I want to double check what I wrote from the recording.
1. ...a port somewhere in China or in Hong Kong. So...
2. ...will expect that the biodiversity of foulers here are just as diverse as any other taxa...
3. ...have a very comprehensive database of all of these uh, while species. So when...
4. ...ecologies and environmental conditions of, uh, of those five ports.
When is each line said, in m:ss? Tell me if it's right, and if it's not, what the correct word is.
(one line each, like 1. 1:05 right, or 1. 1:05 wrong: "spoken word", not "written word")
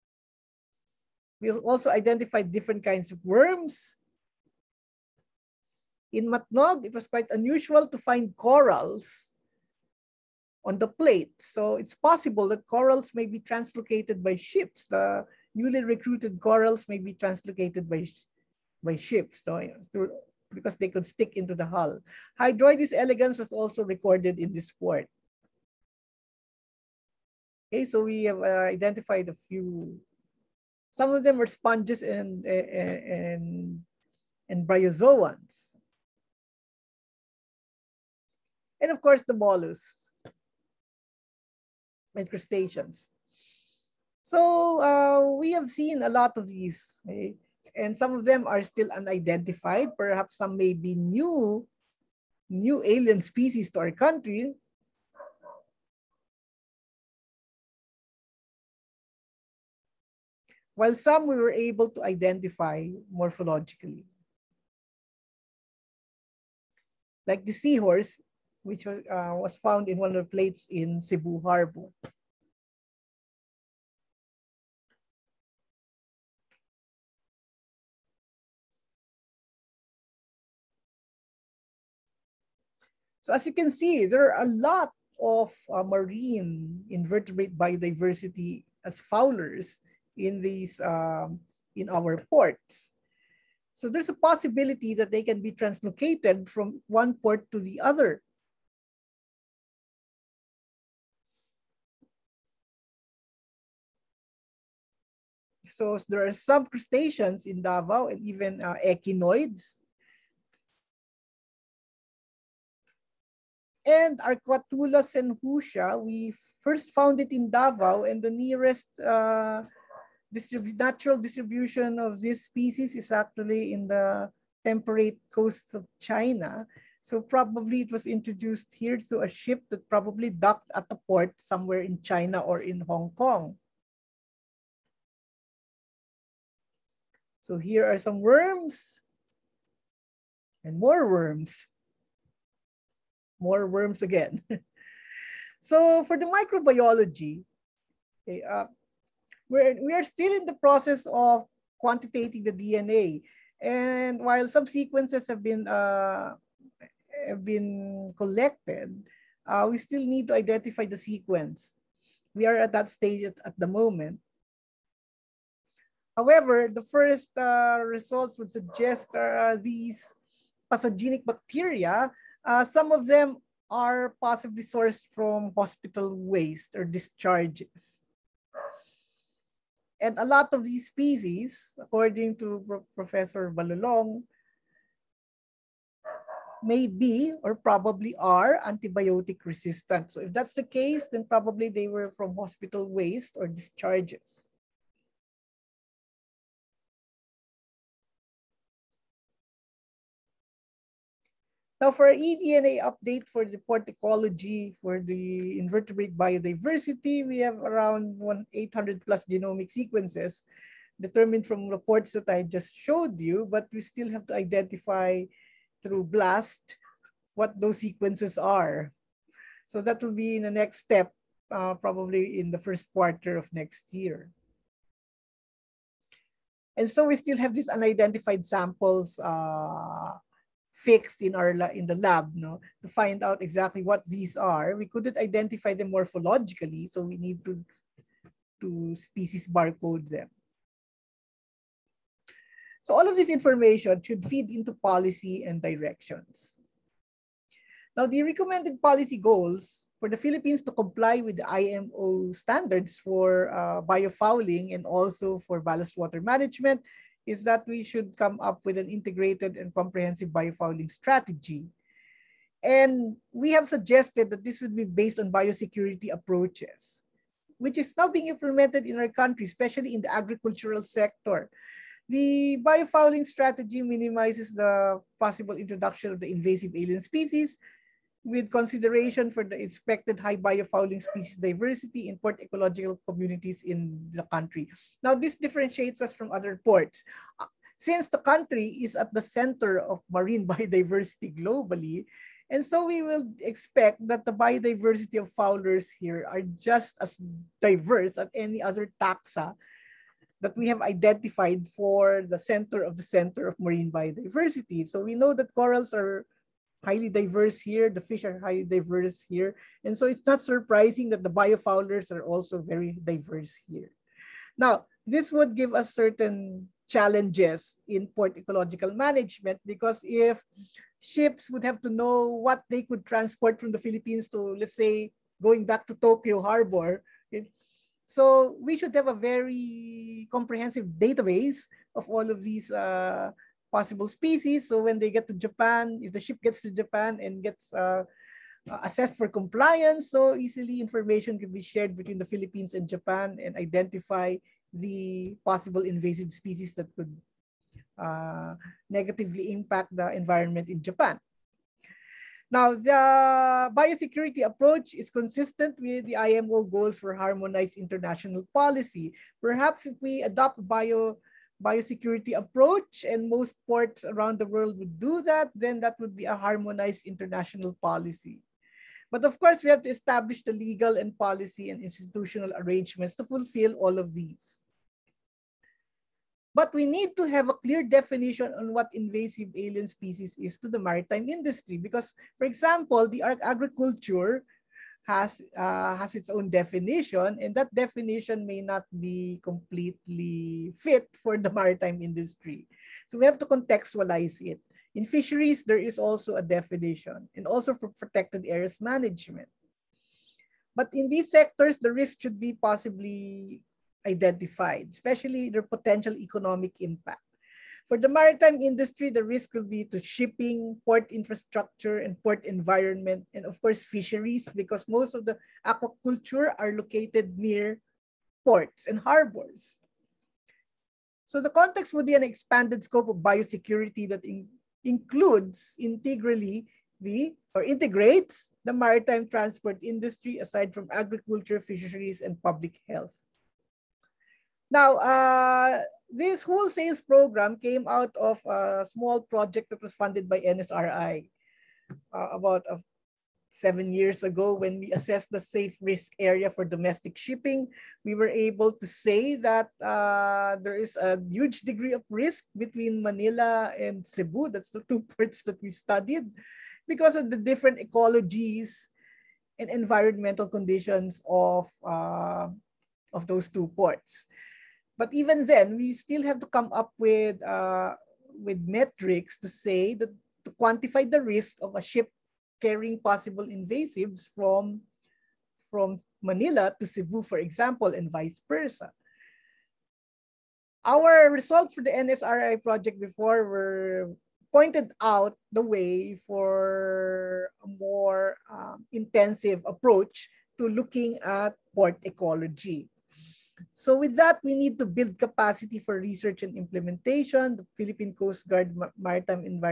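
1. 2:10 right
2. 4:53 right
3. 5:28 wrong: "possible", not "while"
4. 7:37 wrong: "two", not "five".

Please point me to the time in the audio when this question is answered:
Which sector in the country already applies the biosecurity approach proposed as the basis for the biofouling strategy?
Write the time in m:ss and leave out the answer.
4:30.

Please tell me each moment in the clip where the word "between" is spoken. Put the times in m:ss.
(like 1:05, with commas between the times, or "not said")
5:41, 7:32.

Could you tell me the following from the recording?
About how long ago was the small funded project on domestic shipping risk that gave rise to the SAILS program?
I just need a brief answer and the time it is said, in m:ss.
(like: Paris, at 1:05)
seven years, at 7:23.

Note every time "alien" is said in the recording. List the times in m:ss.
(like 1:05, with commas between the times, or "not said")
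0:52, 4:36, 6:19.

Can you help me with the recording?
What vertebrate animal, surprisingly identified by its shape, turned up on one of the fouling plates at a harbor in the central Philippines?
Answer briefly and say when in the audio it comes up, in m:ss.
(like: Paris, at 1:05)
seahorse, at 1:07.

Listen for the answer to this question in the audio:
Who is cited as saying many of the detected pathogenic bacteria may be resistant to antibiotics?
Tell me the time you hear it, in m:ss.
3:03.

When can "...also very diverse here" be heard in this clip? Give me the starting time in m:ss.
5:12.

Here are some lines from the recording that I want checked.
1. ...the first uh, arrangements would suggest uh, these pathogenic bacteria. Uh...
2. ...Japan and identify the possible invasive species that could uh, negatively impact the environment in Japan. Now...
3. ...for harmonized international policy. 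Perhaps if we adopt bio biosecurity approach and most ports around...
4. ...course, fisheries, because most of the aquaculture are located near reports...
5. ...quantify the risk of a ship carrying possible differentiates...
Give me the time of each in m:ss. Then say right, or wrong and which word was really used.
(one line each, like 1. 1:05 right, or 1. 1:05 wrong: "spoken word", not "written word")
1. 2:46 wrong: "results", not "arrangements"
2. 5:42 right
3. 5:56 right
4. 6:53 wrong: "ports", not "reports"
5. 7:50 wrong: "invasives", not "differentiates".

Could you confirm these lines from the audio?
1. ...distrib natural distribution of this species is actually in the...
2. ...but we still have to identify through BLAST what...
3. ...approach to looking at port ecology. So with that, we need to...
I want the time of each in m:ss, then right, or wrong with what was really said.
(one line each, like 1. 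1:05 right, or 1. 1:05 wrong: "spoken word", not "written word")
1. 2:00 right
2. 3:33 right
3. 8:09 right.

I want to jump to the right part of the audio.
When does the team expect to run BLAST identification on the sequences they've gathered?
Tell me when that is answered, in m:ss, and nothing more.
3:42.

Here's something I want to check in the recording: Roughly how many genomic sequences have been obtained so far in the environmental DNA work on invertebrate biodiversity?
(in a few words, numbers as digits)
800 plus.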